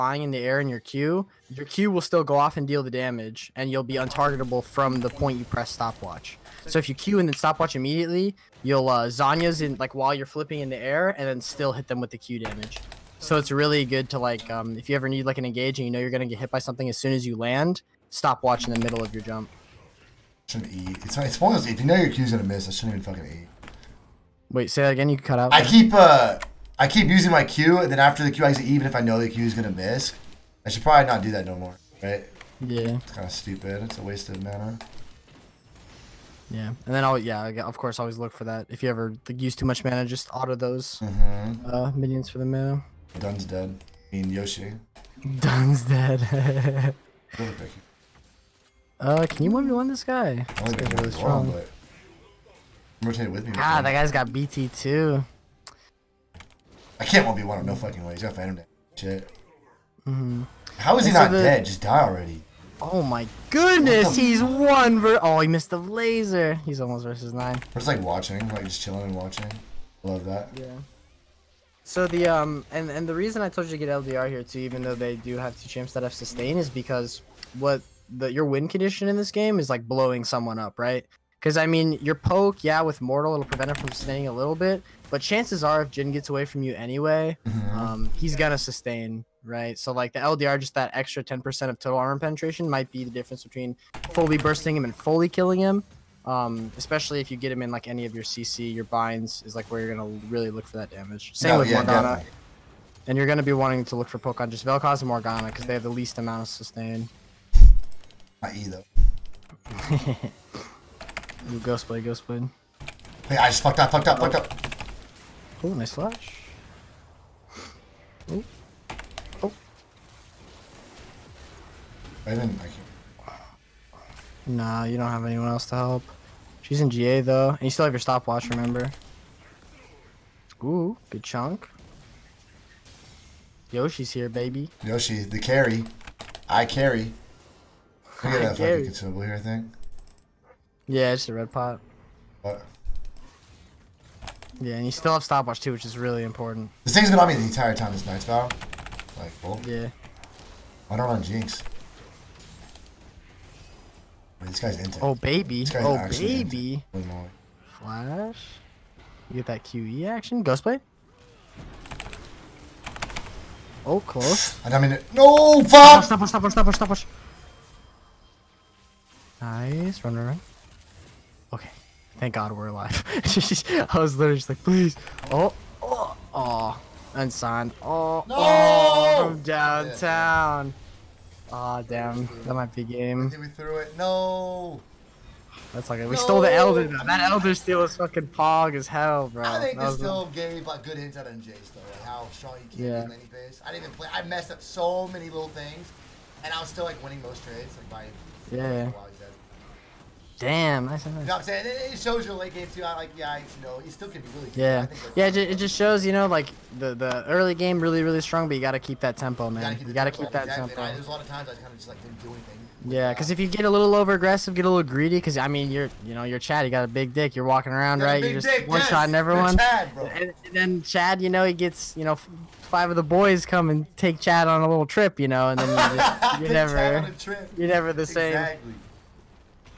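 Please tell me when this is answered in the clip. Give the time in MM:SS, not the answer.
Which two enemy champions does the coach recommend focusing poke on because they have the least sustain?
01:44.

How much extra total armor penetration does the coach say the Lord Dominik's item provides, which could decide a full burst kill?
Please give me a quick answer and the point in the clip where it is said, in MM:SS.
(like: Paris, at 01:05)
10%, at 01:31.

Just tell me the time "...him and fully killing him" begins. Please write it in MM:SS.
01:34.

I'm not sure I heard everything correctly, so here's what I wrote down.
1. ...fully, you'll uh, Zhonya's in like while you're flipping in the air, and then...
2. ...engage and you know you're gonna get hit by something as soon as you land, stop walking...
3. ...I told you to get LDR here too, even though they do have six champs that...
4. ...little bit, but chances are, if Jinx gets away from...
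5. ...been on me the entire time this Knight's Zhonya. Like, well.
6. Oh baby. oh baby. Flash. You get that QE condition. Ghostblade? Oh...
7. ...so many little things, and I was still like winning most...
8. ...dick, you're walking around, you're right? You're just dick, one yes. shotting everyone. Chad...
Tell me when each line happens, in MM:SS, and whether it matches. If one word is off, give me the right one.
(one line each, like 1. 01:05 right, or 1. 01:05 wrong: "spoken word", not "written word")
1. 00:07 wrong: "immediately", not "fully"
2. 00:15 wrong: "watching", not "walking"
3. 01:13 wrong: "two", not "six"
4. 01:24 wrong: "Jhin", not "Jinx"
5. 02:27 wrong: "Vow", not "Zhonya"
6. 02:35 wrong: "action", not "condition"
7. 03:14 right
8. 03:37 right.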